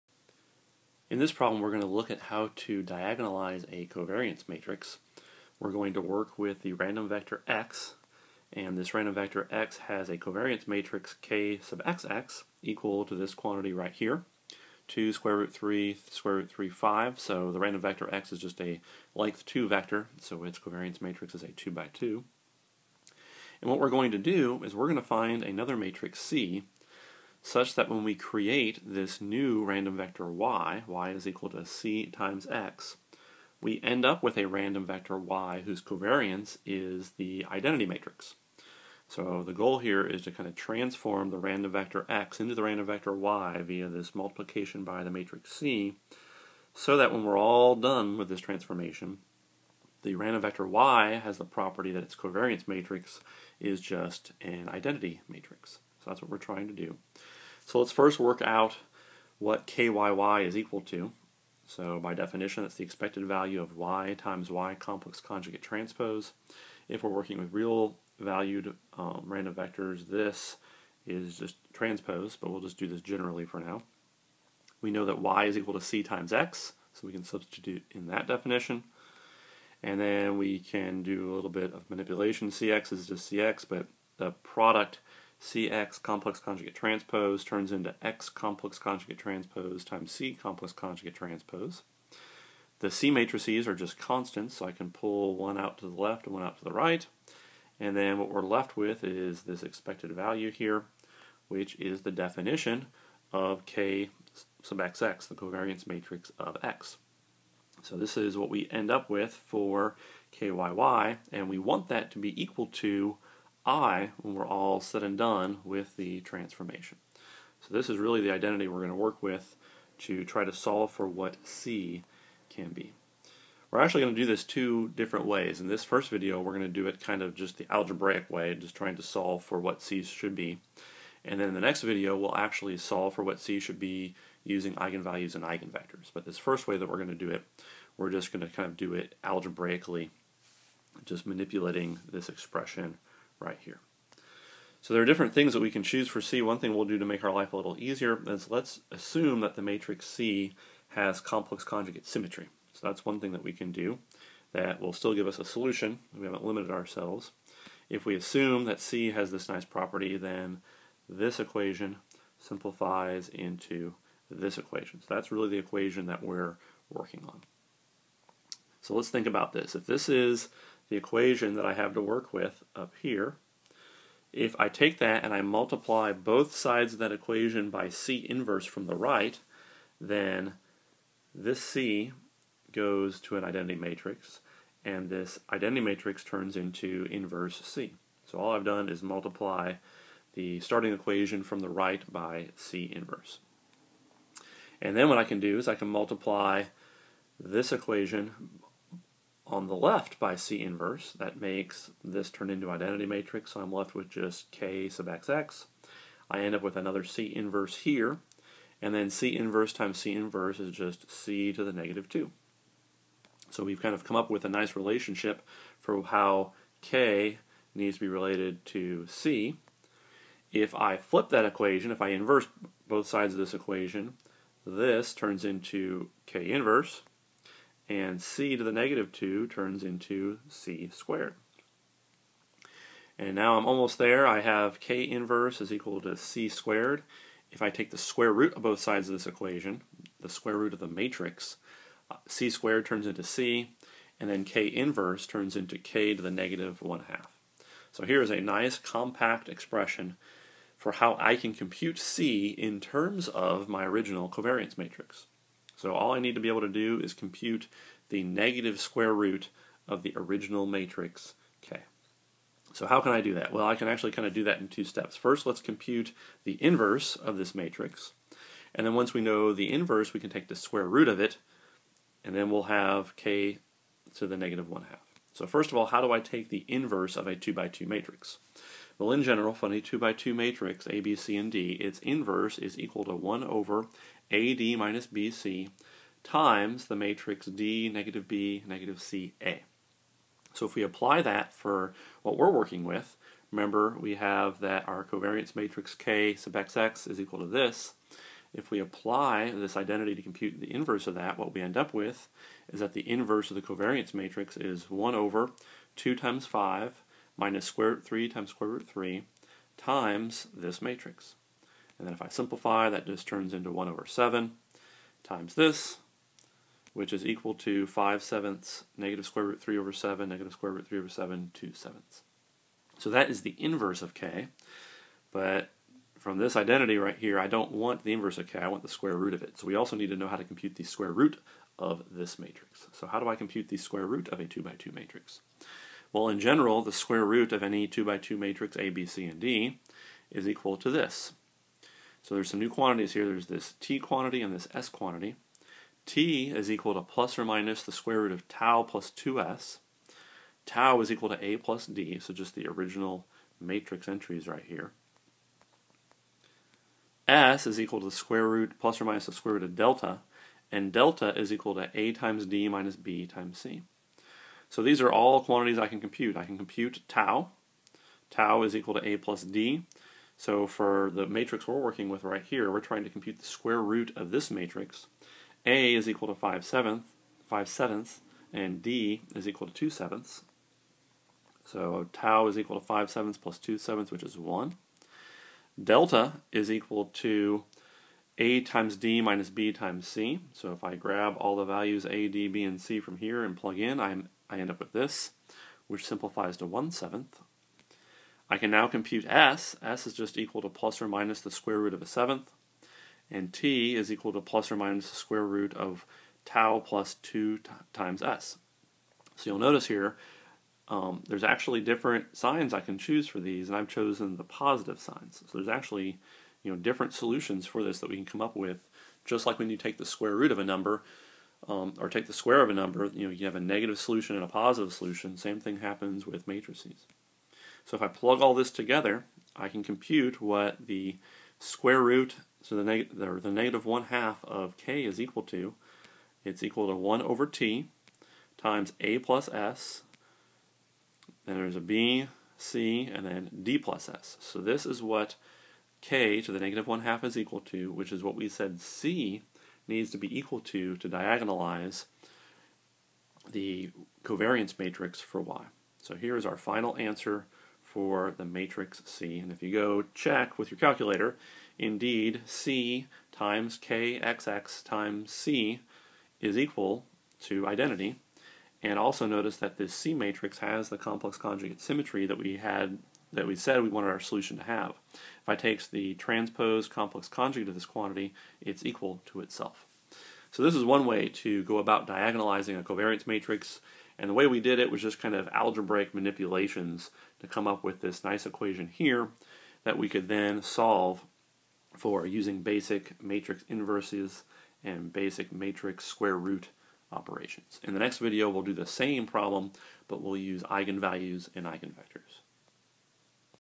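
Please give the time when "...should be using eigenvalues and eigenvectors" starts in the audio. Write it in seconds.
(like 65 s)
133 s.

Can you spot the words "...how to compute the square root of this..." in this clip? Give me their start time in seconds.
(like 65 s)
330 s.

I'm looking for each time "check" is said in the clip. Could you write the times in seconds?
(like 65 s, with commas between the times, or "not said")
460 s.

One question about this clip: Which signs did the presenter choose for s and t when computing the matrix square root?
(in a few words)
The positive signs.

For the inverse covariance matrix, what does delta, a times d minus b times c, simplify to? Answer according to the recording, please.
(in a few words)
1/7.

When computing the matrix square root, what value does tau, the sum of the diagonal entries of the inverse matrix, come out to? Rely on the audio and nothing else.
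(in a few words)
1.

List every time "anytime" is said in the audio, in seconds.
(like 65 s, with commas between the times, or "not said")
not said.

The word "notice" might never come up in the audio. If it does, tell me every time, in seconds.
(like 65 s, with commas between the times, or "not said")
409 s, 469 s.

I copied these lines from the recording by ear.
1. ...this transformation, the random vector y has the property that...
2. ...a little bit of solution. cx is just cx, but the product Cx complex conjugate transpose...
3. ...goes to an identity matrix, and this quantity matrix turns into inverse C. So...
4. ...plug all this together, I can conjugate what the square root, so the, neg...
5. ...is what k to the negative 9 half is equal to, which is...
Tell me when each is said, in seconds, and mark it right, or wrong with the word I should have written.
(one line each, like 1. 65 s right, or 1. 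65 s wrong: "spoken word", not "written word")
1. 48 s right
2. 81 s wrong: "manipulation", not "solution"
3. 182 s wrong: "identity", not "quantity"
4. 428 s wrong: "compute", not "conjugate"
5. 444 s wrong: "1", not "9".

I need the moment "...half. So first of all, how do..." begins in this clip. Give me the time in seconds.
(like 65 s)
274 s.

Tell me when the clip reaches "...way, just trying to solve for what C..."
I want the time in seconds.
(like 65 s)
128 s.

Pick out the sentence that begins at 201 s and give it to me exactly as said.
That makes this turn into identity matrix, so I'm left with just K sub XX.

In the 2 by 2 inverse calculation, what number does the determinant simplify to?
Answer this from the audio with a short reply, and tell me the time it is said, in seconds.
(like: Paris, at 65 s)
7, at 313 s.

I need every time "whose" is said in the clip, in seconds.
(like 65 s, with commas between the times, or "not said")
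35 s.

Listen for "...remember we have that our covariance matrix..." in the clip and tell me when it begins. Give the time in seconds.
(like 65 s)
293 s.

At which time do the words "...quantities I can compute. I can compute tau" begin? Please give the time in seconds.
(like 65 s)
365 s.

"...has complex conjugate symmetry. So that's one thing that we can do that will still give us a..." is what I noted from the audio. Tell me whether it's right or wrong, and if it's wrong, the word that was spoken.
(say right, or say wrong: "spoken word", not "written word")
right.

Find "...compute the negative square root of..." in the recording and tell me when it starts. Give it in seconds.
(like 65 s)
257 s.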